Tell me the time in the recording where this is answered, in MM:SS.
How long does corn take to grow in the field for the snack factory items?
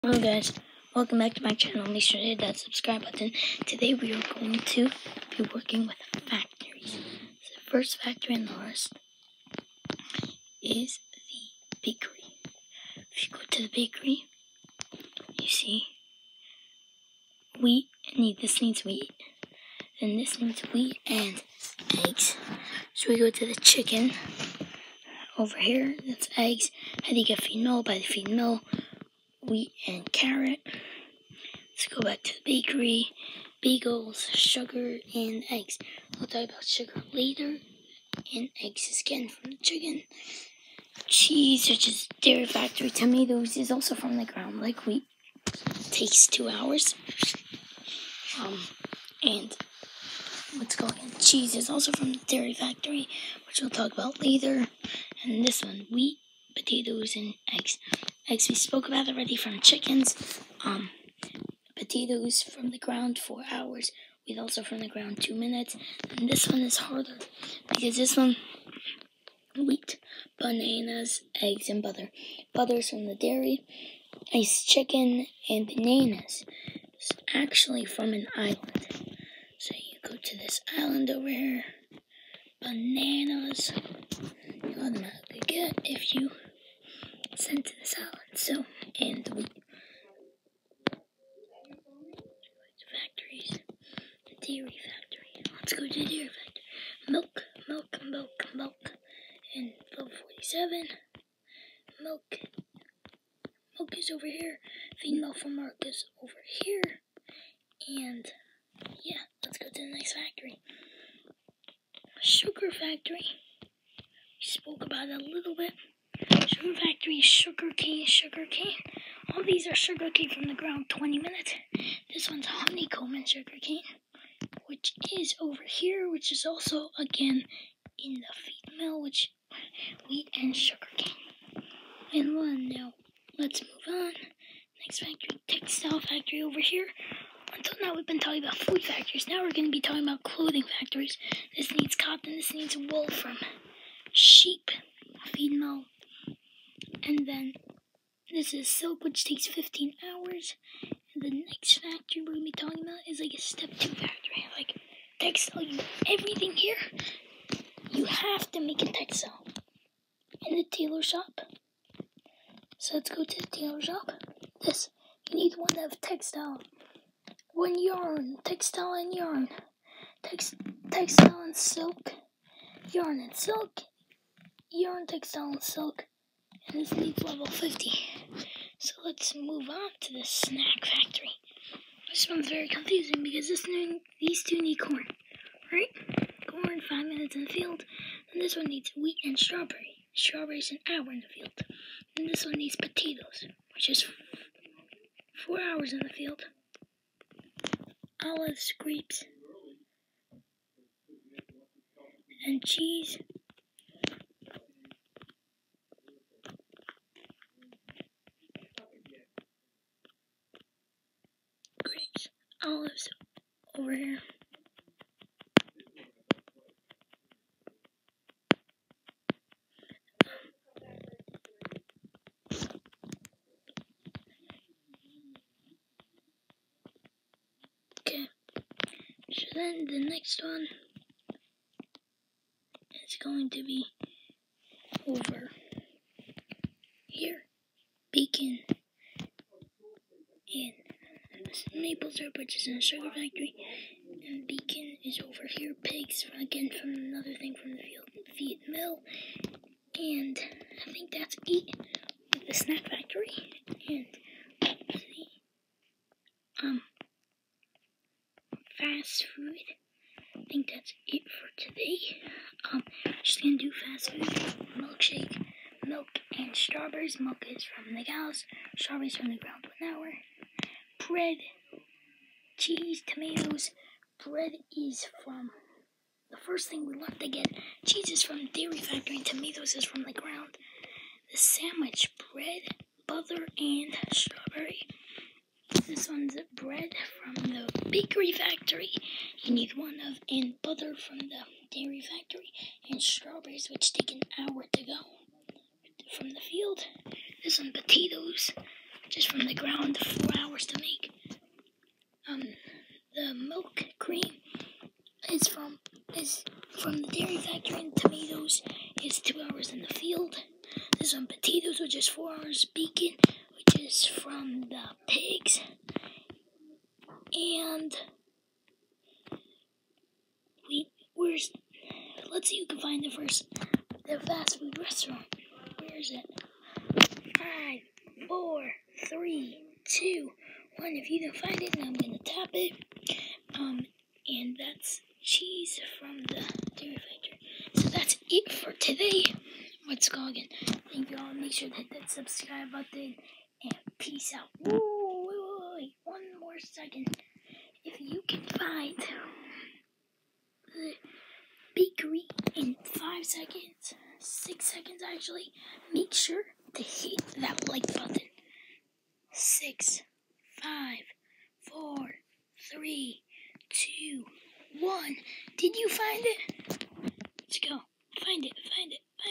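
03:06.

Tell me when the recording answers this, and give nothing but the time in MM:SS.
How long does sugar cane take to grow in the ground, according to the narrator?
02:00.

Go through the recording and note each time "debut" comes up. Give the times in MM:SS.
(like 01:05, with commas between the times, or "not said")
not said.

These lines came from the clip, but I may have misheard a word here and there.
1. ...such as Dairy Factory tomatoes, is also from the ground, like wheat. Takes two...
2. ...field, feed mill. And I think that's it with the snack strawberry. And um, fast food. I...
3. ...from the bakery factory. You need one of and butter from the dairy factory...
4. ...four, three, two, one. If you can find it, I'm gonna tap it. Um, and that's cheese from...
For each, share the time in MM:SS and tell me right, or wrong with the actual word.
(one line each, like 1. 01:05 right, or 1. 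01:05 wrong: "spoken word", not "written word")
1. 00:41 right
2. 04:07 wrong: "factory", not "strawberry"
3. 04:47 right
4. 05:28 right.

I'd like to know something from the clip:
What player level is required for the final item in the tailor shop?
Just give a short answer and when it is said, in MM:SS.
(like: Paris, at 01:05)
level 50, at 02:57.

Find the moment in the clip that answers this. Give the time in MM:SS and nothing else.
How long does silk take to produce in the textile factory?
02:29.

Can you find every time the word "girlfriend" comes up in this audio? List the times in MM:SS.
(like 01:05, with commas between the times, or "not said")
not said.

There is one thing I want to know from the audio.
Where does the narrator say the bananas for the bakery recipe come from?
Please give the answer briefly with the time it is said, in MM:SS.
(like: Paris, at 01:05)
an island, at 01:16.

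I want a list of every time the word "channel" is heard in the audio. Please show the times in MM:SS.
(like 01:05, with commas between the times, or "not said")
00:01.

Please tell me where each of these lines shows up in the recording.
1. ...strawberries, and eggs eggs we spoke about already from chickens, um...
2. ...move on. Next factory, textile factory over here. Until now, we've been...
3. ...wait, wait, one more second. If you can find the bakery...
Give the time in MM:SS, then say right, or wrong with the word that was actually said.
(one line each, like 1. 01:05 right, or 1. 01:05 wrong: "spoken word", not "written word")
1. 00:56 wrong: "potatoes", not "strawberries"
2. 02:13 right
3. 05:44 right.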